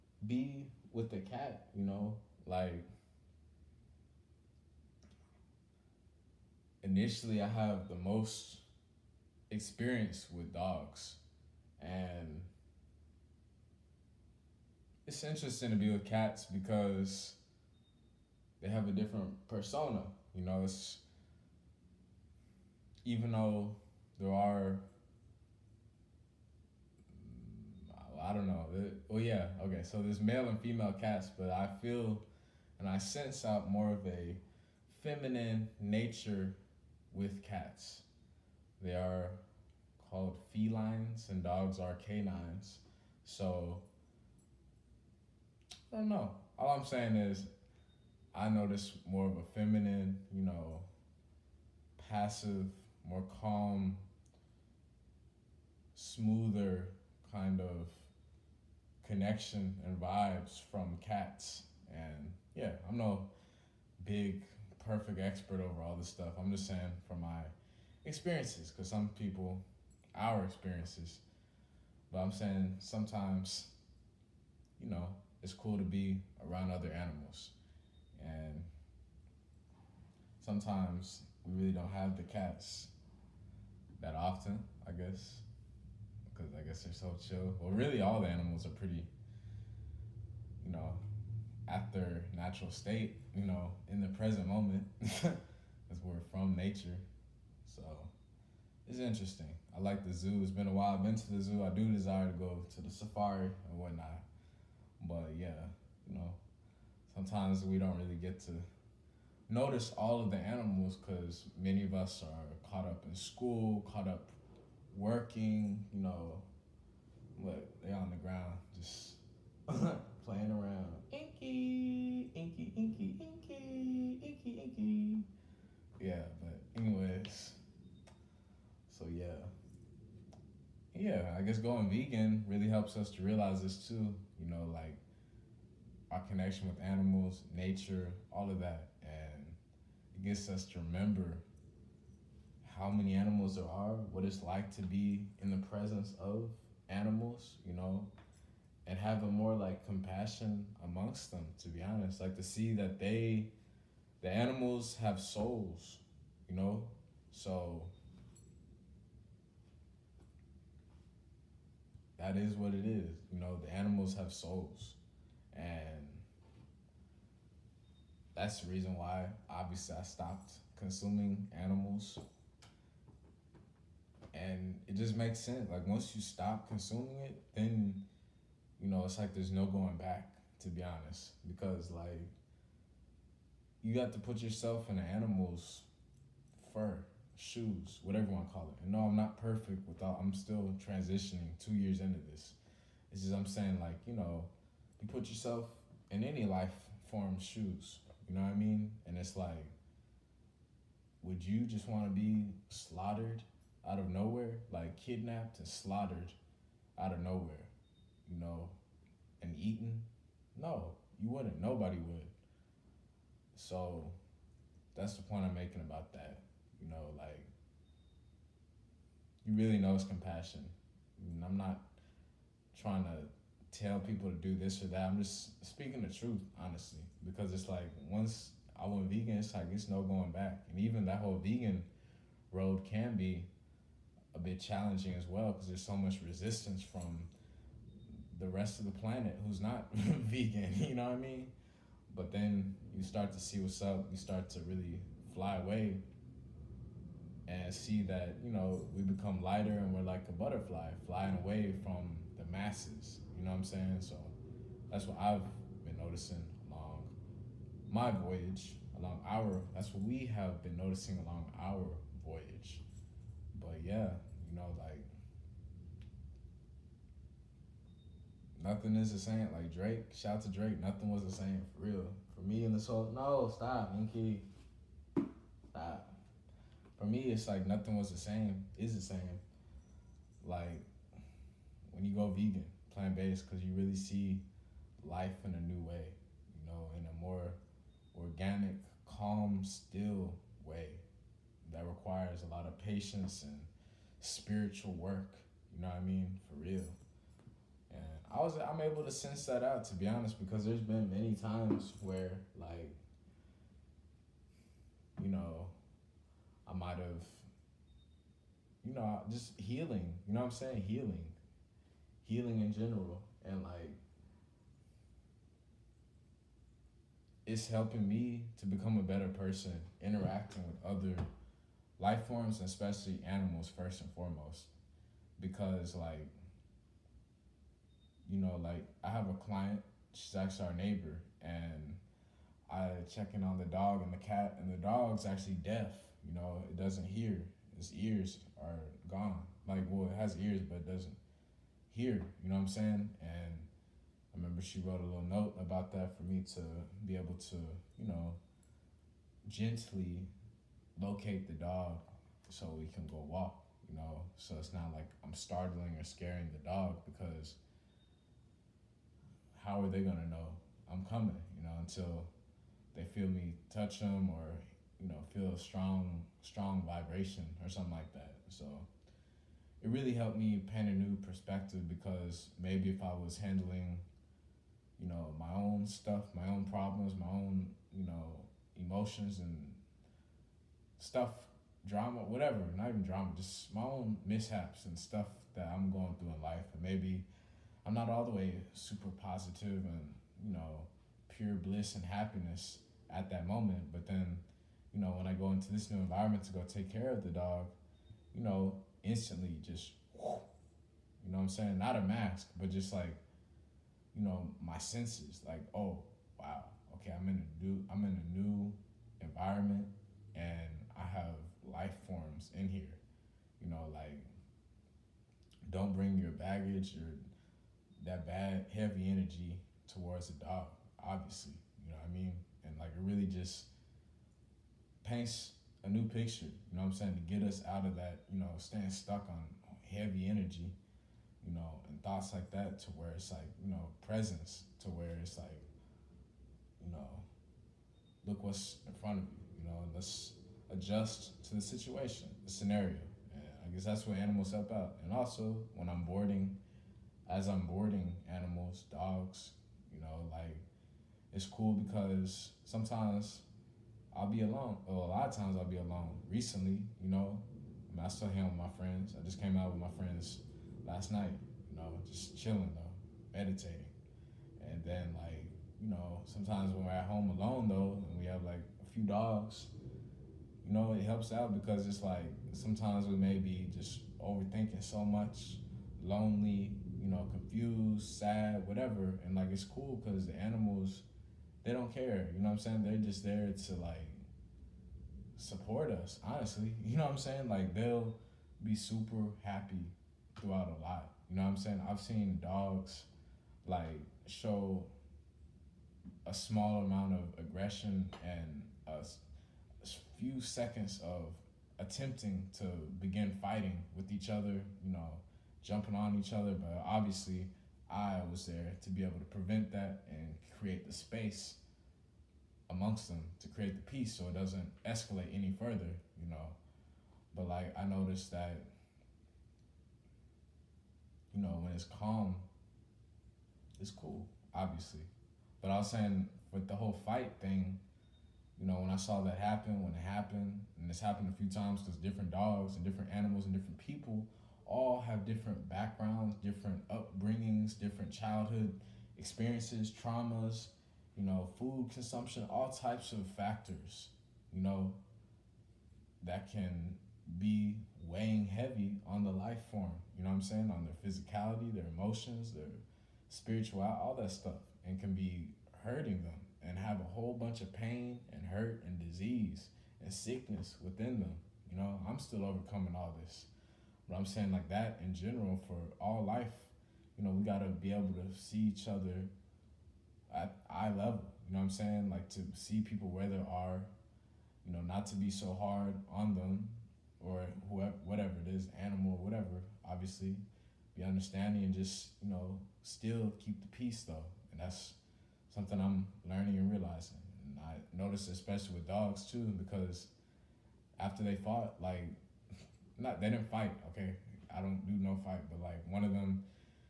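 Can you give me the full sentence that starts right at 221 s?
I mean, I'm not trying to tell people to do this or that.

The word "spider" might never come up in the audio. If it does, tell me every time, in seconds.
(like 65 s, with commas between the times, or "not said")
not said.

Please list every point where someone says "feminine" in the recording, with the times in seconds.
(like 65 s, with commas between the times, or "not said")
35 s, 49 s.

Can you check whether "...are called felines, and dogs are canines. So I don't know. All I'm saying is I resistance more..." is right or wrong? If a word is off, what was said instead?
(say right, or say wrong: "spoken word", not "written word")
wrong: "notice", not "resistance".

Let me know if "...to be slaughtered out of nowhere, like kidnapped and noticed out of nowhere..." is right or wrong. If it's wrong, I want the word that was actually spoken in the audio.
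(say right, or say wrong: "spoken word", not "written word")
wrong: "slaughtered", not "noticed".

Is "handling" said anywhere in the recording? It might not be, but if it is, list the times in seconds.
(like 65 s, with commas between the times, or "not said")
373 s.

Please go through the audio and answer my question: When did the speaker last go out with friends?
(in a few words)
last night.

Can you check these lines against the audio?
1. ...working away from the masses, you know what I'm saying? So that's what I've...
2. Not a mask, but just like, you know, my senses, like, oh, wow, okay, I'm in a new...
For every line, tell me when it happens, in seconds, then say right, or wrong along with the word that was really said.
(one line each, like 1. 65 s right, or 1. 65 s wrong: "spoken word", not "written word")
1. 251 s wrong: "flying", not "working"
2. 401 s right.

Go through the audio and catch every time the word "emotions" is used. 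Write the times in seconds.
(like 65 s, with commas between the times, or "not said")
378 s, 551 s.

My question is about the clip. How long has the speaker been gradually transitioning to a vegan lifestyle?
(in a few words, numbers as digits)
2 years.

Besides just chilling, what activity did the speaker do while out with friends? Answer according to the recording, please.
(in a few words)
meditating.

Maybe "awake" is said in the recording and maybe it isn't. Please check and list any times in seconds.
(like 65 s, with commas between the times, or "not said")
not said.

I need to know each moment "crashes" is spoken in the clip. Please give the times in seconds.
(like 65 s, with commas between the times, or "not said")
not said.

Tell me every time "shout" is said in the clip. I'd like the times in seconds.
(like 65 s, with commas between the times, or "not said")
270 s.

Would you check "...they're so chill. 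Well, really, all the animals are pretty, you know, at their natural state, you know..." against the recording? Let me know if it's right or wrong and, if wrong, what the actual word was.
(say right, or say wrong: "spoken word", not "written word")
right.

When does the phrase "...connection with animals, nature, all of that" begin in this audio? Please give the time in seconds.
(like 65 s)
136 s.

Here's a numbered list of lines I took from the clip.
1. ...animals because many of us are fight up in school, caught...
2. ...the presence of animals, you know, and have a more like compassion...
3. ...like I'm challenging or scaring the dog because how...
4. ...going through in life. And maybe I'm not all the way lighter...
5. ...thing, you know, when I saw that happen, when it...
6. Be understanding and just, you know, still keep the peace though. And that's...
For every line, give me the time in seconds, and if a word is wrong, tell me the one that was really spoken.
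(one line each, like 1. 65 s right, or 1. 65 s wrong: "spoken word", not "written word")
1. 110 s wrong: "caught", not "fight"
2. 145 s right
3. 354 s wrong: "startling", not "challenging"
4. 385 s wrong: "super", not "lighter"
5. 527 s right
6. 580 s right.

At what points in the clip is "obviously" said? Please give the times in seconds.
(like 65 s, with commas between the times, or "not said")
169 s, 421 s, 506 s, 524 s, 579 s.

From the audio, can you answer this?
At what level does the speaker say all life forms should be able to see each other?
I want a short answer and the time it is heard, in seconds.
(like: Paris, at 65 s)
eye level, at 570 s.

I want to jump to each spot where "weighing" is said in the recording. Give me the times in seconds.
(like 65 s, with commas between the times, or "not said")
548 s.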